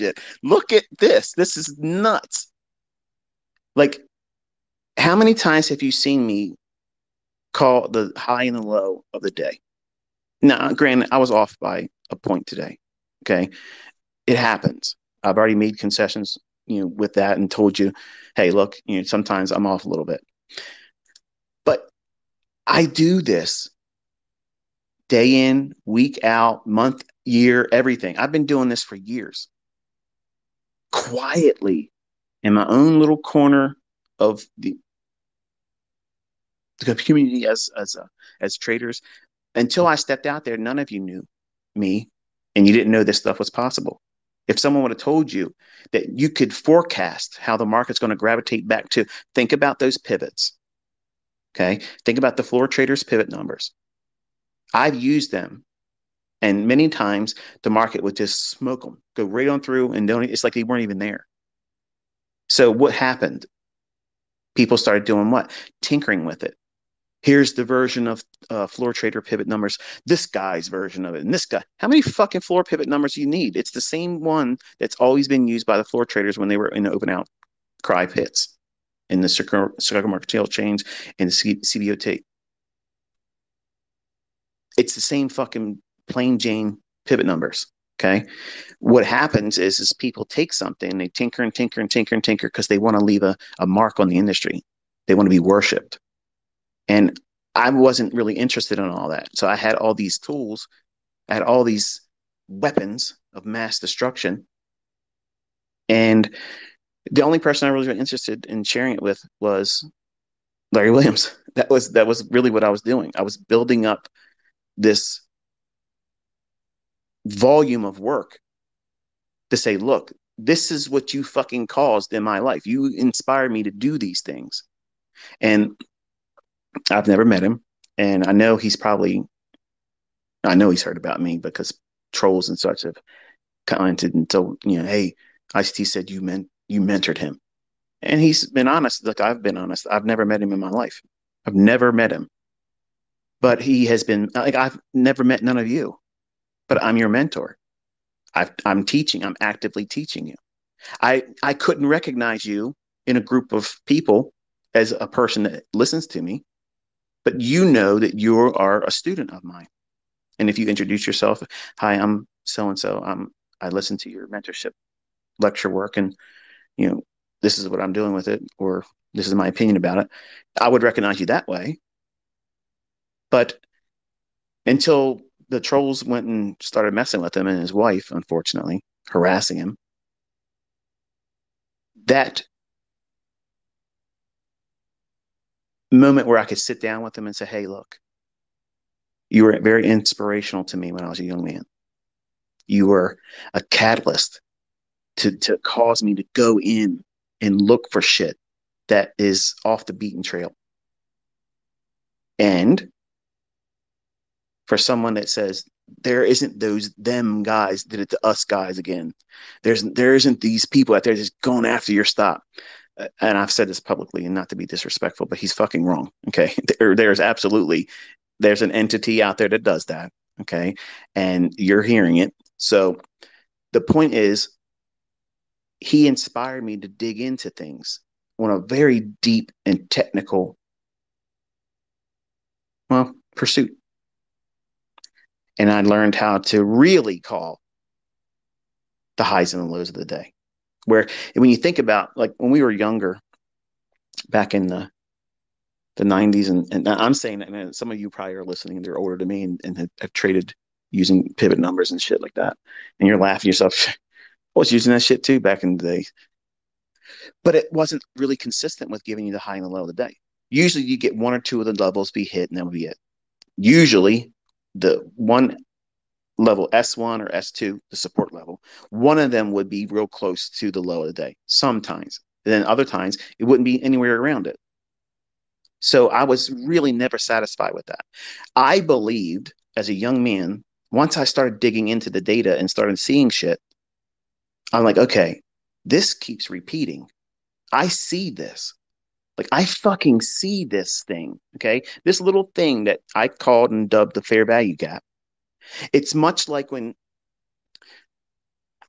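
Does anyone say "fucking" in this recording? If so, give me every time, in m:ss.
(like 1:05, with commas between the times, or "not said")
1:12, 1:25, 2:01, 3:35, 4:49.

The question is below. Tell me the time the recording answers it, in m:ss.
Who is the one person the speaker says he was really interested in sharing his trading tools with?
1:50.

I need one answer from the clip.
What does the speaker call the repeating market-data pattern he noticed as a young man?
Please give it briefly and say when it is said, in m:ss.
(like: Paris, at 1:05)
fair value gap, at 4:54.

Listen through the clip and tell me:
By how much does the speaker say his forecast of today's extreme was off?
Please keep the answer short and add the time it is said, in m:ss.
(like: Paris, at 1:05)
a point, at 0:11.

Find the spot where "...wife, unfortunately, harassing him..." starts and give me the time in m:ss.
2:57.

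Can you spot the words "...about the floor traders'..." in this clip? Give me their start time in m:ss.
0:52.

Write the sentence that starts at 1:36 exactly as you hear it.
And I wasn't really interested in all that.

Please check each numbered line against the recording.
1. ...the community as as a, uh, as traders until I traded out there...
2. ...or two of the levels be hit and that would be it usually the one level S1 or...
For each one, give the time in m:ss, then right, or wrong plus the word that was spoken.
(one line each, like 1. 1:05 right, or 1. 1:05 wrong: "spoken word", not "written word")
1. 0:36 wrong: "stepped", not "traded"
2. 4:21 right.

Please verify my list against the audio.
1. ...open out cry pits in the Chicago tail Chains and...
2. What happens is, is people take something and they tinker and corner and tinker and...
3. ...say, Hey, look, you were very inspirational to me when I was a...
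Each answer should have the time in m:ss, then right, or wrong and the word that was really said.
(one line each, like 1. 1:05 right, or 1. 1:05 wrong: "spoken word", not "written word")
1. 1:16 right
2. 1:28 wrong: "tinker", not "corner"
3. 3:07 right.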